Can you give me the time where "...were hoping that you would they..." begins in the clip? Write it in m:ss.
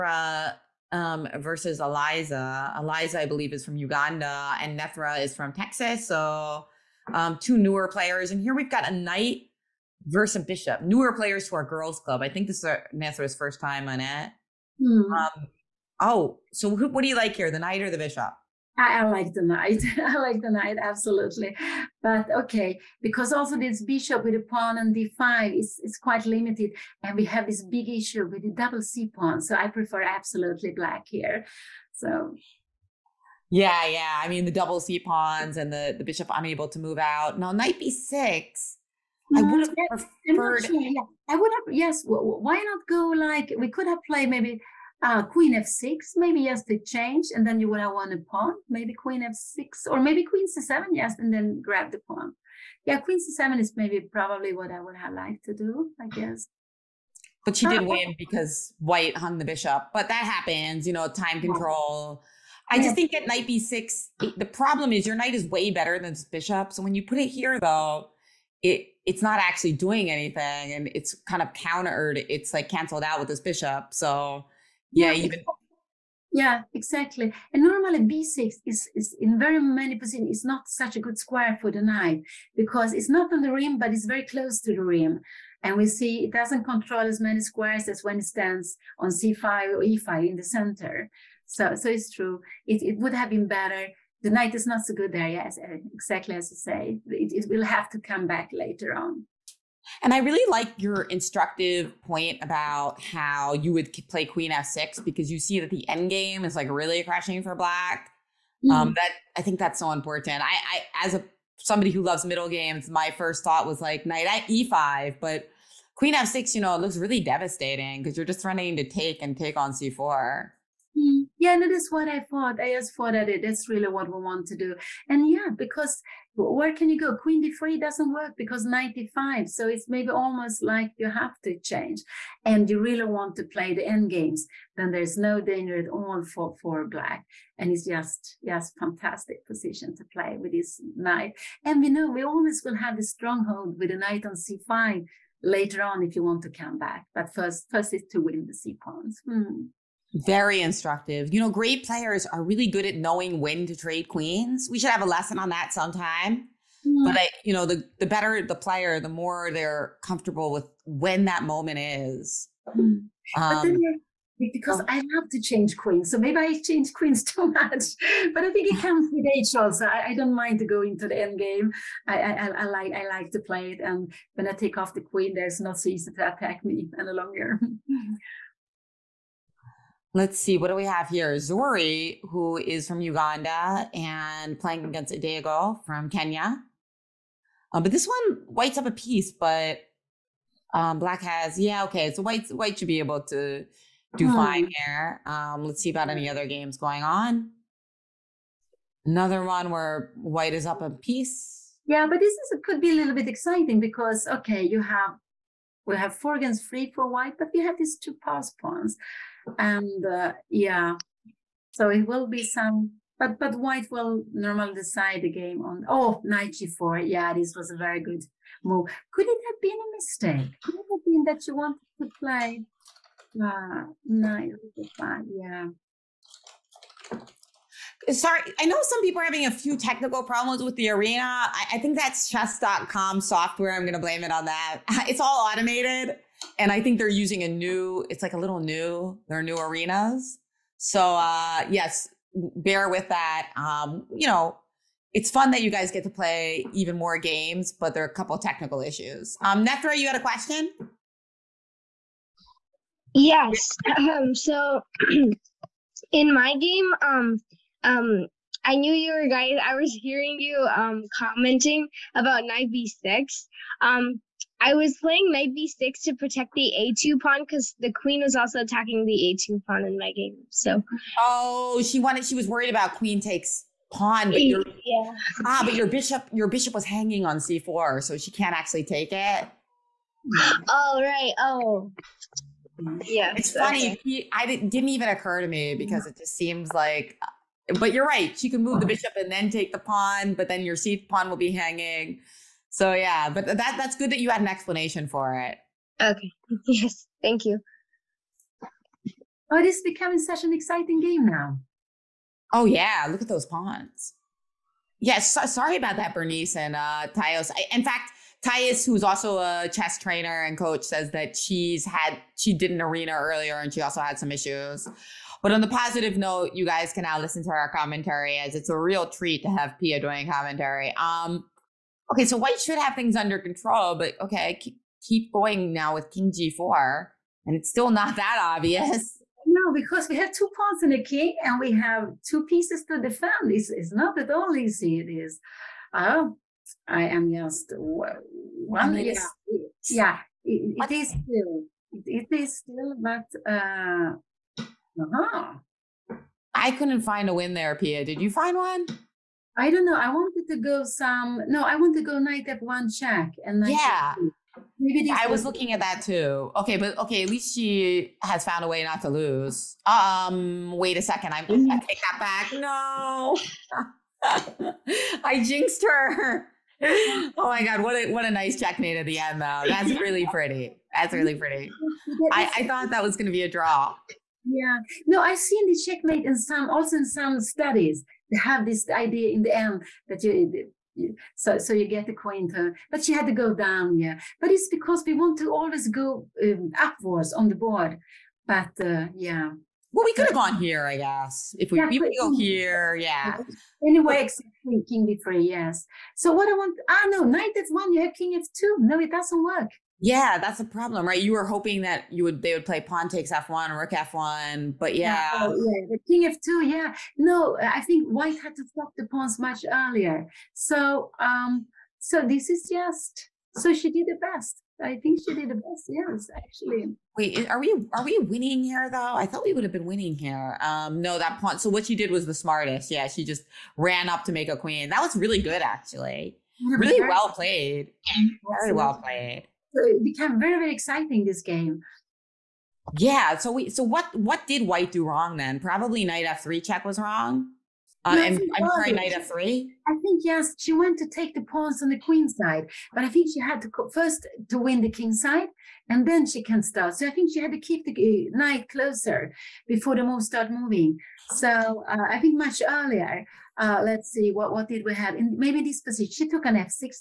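6:41.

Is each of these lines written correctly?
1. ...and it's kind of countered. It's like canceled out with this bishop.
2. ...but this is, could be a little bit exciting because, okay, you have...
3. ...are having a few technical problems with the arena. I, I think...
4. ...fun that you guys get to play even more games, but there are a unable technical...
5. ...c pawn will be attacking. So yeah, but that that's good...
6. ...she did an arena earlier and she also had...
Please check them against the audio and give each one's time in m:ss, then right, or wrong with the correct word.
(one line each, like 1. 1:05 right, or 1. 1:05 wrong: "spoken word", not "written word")
1. 1:10 right
2. 3:22 right
3. 3:49 right
4. 4:05 wrong: "couple", not "unable"
5. 4:50 wrong: "hanging", not "attacking"
6. 5:12 right.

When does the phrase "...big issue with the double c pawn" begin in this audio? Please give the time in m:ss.
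0:27.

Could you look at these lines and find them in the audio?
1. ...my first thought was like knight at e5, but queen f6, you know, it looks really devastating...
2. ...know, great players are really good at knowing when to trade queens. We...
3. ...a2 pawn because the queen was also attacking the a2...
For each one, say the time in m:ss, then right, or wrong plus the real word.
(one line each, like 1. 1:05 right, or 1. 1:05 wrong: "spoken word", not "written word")
1. 1:52 right
2. 2:31 right
3. 4:26 right.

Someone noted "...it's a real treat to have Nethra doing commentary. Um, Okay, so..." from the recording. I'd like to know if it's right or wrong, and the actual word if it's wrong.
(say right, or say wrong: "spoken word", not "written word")
wrong: "Pia", not "Nethra".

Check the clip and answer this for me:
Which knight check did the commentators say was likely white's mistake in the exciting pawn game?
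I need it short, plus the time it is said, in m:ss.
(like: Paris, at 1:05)
Knight f3 check, at 7:16.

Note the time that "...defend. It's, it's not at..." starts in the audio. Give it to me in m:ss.
5:33.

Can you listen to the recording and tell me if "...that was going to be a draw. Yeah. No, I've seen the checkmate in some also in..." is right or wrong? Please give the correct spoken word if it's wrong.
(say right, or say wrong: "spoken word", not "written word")
right.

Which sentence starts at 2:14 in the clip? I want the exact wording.
Then there's no danger at all for, for black.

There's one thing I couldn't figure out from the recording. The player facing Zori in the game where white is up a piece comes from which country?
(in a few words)
Kenya.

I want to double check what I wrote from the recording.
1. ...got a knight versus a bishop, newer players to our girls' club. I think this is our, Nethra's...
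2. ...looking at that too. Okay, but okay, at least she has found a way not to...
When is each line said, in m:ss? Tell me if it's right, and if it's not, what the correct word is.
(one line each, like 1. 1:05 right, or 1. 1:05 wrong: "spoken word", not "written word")
1. 0:08 right
2. 5:55 right.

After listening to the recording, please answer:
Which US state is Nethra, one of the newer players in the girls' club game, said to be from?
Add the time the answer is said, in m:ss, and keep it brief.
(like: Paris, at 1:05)
Texas, at 0:05.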